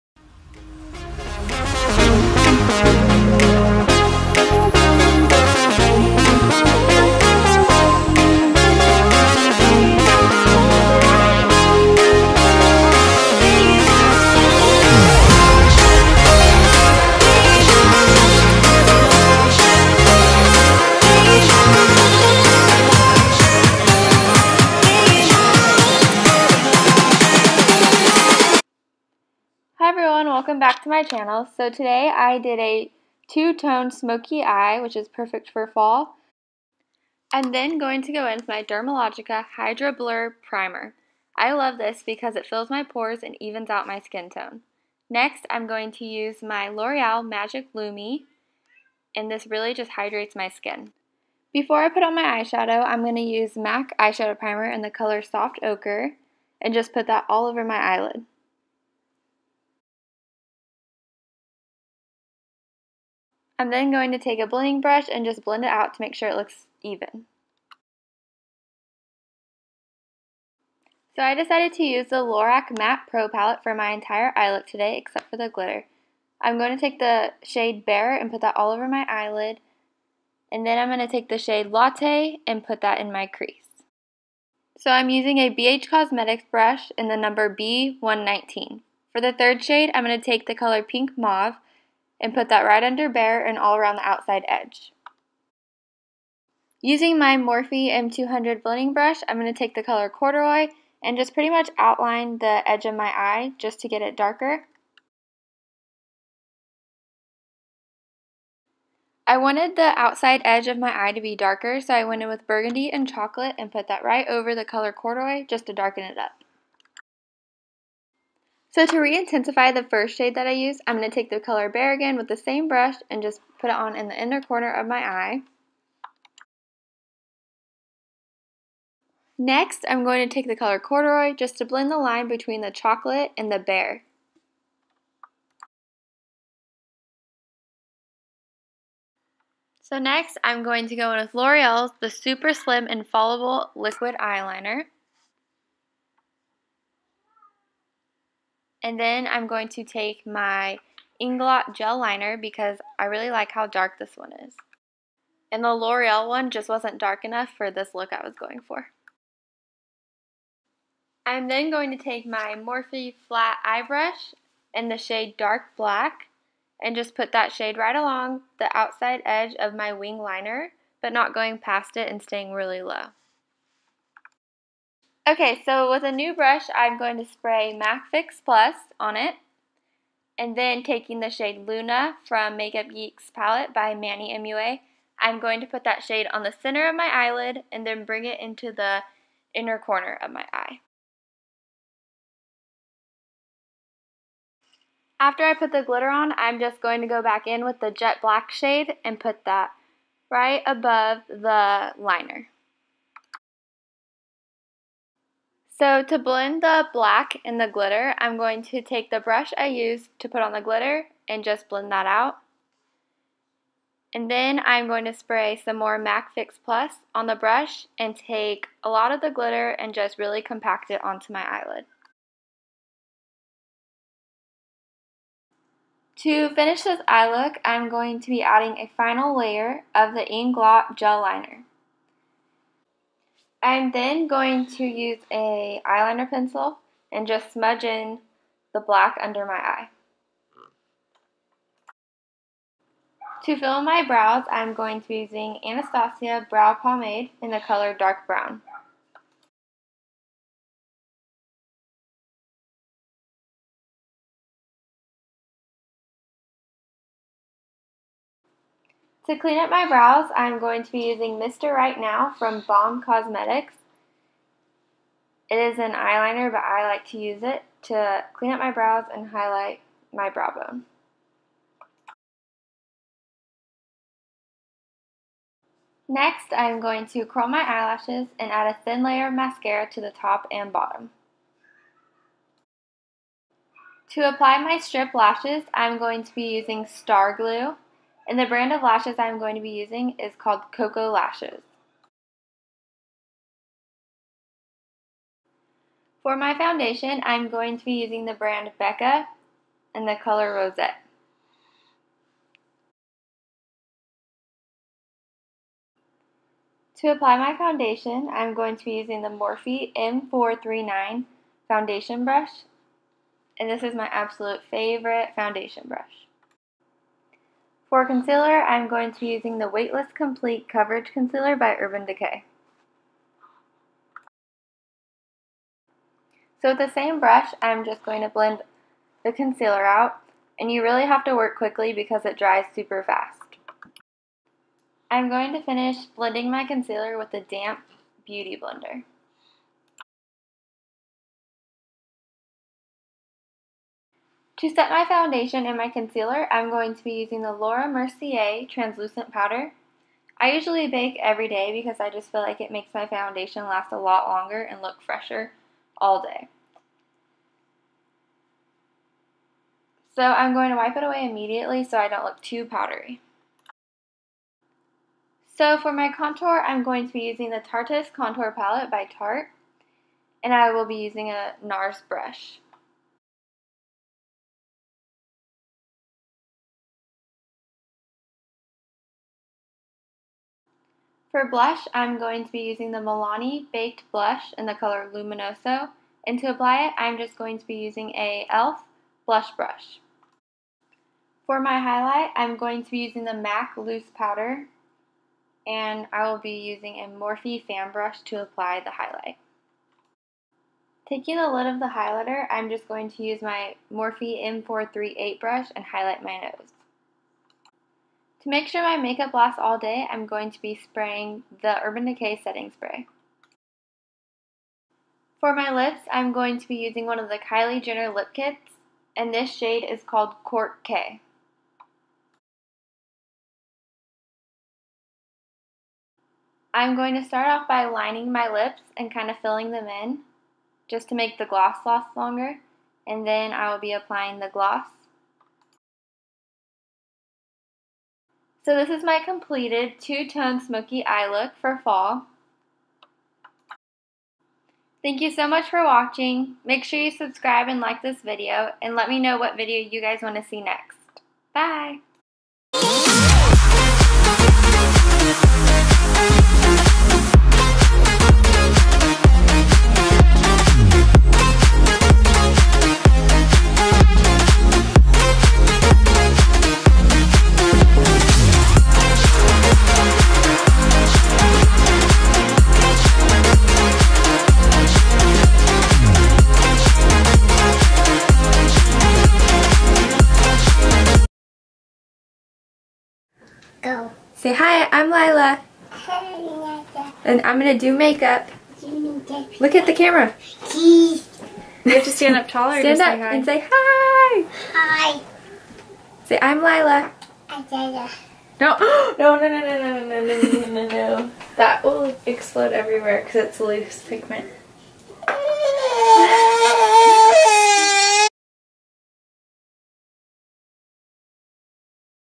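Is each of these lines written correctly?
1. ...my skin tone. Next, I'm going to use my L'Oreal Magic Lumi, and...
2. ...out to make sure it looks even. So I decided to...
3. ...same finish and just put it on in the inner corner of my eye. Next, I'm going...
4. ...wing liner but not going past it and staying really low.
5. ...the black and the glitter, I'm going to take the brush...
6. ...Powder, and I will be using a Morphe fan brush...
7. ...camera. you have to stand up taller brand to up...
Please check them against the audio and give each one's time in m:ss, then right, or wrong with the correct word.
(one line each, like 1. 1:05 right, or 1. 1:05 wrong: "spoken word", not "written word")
1. 0:43 right
2. 1:05 right
3. 2:02 wrong: "brush", not "finish"
4. 2:49 right
5. 3:26 right
6. 6:34 right
7. 8:09 wrong: "stand", not "brand".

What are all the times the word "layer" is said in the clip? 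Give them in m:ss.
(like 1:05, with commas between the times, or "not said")
3:49, 4:39.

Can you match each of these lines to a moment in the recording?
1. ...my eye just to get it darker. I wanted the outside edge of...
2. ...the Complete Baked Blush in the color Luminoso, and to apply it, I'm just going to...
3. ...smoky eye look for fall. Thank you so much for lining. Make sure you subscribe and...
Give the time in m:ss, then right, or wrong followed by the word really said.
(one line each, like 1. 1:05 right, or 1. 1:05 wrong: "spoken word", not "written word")
1. 1:42 right
2. 6:22 wrong: "Milani", not "Complete"
3. 7:20 wrong: "watching", not "lining".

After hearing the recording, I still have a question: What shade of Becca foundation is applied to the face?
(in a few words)
Rosette.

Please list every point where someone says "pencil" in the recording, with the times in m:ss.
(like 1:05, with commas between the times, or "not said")
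3:56.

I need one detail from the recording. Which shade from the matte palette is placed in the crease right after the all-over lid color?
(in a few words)
Latte.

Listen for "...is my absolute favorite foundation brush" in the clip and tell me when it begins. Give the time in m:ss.
5:13.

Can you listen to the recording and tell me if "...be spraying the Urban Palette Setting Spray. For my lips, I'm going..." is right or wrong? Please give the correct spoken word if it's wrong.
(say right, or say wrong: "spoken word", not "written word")
wrong: "Decay", not "Palette".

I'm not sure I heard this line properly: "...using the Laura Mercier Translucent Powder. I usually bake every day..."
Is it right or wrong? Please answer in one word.
right.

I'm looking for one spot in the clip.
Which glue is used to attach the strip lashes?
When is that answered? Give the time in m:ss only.
4:46.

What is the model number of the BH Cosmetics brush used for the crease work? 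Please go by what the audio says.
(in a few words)
B119.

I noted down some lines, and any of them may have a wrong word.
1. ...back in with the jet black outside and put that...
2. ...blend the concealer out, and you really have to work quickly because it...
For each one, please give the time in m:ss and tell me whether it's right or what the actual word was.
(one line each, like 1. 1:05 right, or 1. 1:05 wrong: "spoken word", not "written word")
1. 3:17 wrong: "shade", not "outside"
2. 5:28 right.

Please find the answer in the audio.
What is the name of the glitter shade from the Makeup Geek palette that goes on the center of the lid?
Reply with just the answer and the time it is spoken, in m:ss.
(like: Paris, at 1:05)
Luna, at 3:01.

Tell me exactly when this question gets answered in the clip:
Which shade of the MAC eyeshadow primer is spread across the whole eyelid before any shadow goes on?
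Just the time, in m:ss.
0:55.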